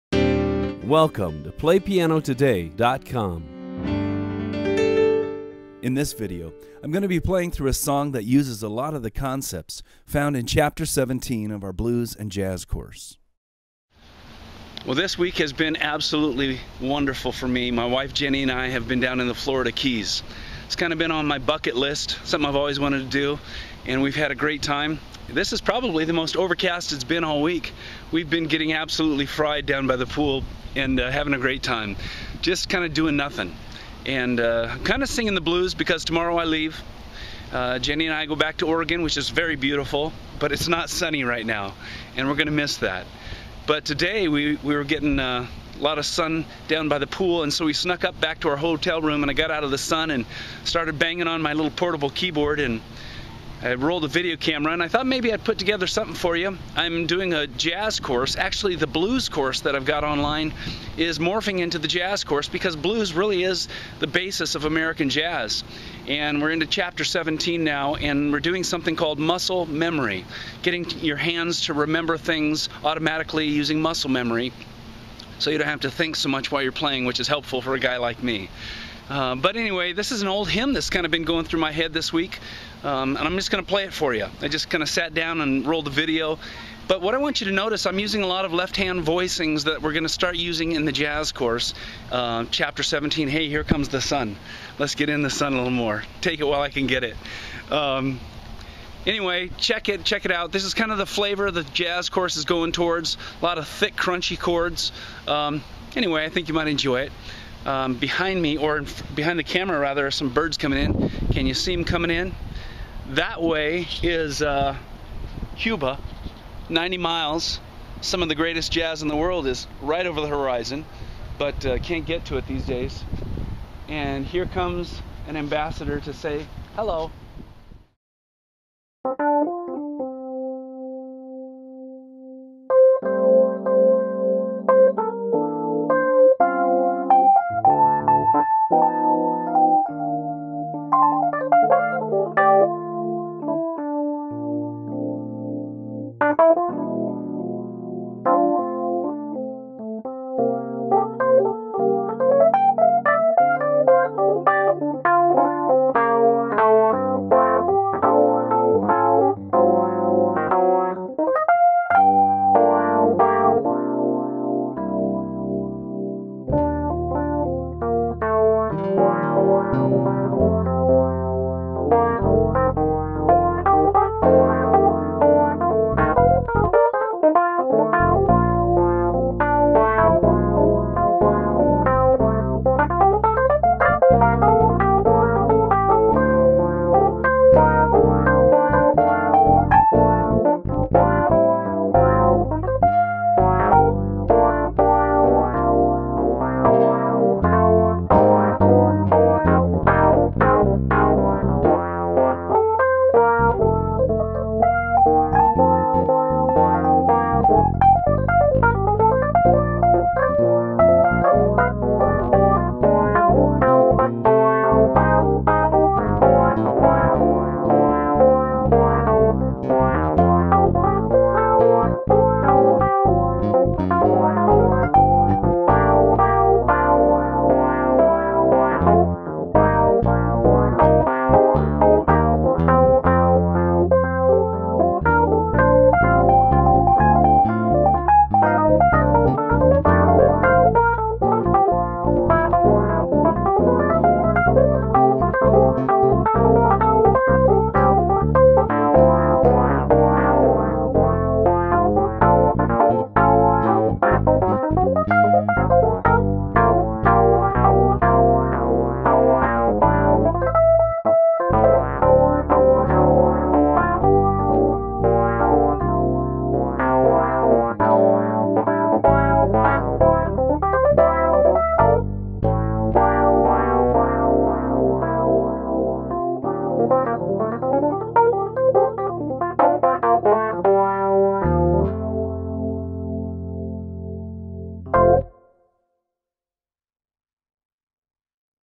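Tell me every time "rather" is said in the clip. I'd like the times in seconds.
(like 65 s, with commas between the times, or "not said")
109 s.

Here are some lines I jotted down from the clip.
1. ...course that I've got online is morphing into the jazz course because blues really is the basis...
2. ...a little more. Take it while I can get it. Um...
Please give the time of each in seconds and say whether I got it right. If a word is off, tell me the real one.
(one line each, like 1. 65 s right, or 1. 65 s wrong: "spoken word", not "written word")
1. 59 s right
2. 95 s right.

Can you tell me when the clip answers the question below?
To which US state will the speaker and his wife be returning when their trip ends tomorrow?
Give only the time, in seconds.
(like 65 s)
38 s.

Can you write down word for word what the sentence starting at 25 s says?
This is probably the most overcast it's been all week.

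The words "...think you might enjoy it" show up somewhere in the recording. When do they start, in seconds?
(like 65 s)
106 s.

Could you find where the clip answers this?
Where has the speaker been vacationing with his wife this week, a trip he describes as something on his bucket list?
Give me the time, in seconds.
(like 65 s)
19 s.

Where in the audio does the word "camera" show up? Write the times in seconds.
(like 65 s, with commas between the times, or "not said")
54 s, 109 s.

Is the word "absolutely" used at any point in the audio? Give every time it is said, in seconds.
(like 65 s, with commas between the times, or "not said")
15 s, 28 s.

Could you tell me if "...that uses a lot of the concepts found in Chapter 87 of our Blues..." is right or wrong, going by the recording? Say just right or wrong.
wrong.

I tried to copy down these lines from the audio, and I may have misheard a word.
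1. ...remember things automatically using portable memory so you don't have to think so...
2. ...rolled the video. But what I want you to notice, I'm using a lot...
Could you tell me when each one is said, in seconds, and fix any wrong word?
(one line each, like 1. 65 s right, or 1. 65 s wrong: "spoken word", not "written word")
1. 71 s wrong: "muscle", not "portable"
2. 85 s right.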